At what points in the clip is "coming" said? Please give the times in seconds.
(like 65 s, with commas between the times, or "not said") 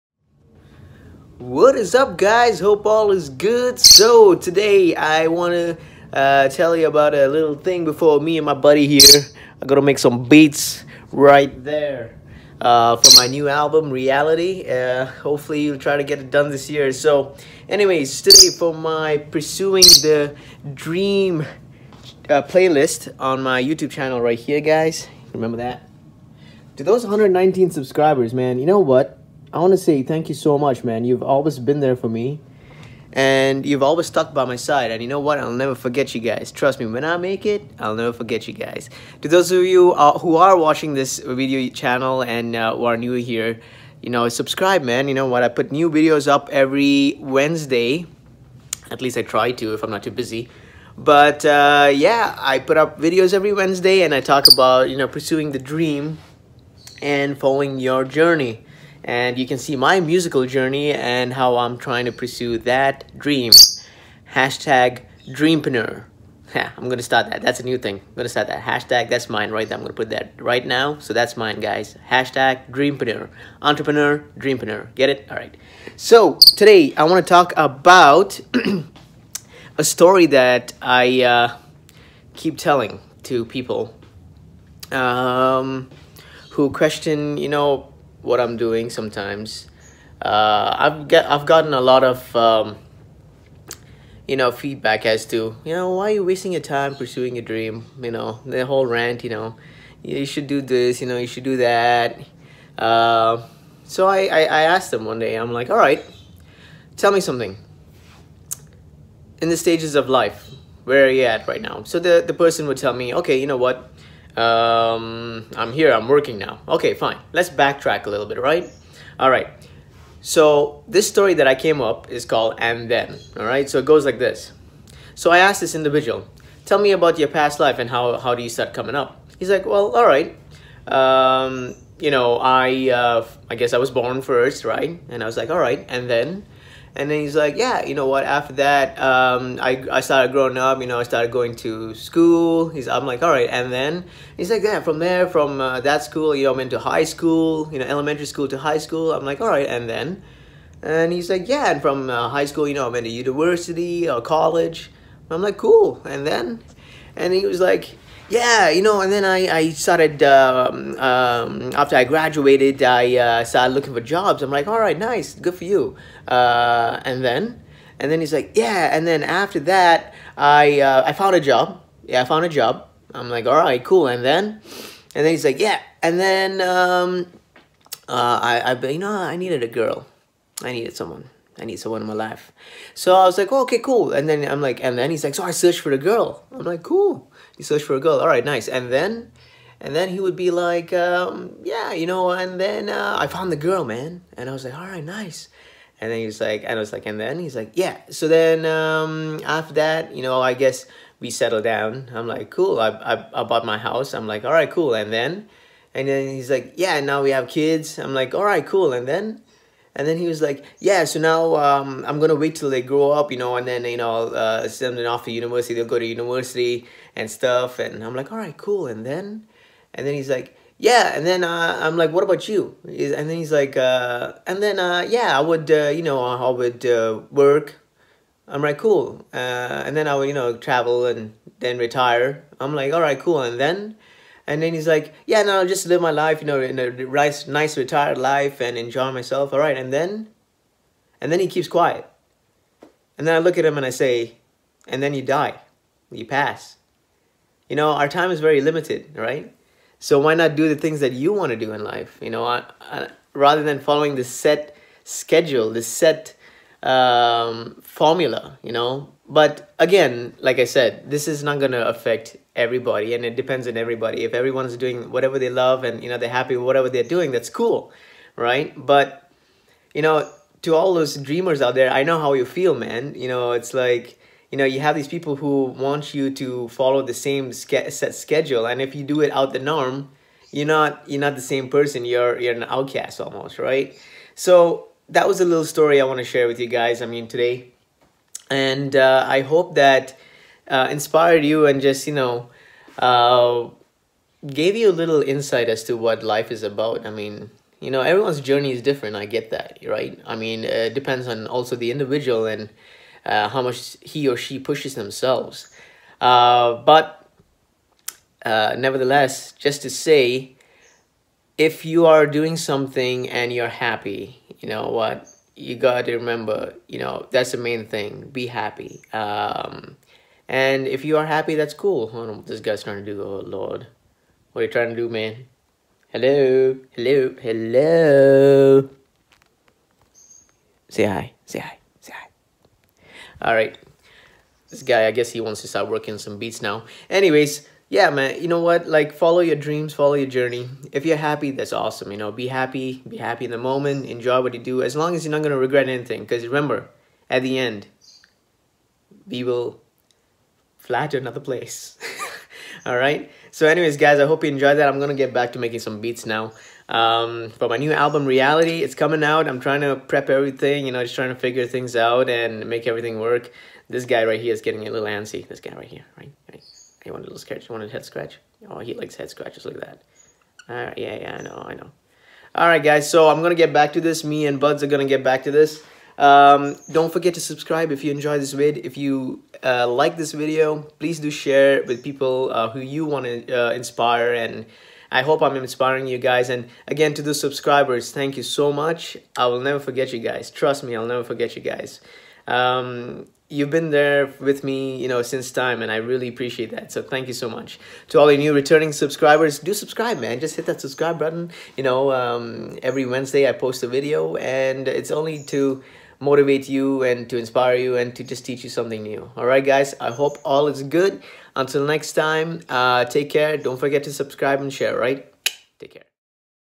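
128 s, 358 s.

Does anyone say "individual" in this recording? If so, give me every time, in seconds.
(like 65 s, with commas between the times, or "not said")
125 s, 301 s.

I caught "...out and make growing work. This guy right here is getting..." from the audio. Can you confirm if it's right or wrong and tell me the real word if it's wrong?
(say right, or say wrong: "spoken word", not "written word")
wrong: "everything", not "growing".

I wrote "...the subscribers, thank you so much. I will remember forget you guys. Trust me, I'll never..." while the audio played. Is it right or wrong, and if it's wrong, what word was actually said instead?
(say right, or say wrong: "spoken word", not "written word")
wrong: "never", not "remember".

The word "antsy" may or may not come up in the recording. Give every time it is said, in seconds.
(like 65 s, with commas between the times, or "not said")
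365 s.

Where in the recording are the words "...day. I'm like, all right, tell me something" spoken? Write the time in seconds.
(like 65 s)
105 s.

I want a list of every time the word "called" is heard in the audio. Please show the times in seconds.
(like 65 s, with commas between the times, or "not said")
122 s.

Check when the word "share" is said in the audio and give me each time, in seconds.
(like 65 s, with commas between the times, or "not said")
286 s, 381 s, 414 s.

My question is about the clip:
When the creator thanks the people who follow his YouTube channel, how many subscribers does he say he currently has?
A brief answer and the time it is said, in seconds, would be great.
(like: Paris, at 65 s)
119, at 27 s.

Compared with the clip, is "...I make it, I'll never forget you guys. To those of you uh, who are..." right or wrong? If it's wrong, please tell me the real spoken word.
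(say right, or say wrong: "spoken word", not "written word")
right.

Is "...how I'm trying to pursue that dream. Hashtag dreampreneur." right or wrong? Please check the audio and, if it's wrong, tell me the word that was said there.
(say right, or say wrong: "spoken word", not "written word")
right.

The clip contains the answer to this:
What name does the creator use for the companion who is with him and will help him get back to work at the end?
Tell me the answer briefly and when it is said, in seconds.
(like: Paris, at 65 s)
Buds, at 374 s.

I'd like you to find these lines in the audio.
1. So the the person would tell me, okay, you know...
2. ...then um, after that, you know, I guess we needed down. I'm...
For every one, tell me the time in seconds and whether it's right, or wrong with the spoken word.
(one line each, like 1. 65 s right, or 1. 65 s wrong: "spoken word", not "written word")
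1. 111 s right
2. 198 s wrong: "settled", not "needed".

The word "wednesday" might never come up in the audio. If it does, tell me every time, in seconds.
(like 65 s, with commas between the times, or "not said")
47 s, 53 s, 403 s.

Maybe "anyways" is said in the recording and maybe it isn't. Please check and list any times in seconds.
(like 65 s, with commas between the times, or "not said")
17 s, 337 s, 353 s.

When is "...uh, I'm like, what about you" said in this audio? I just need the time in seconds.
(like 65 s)
221 s.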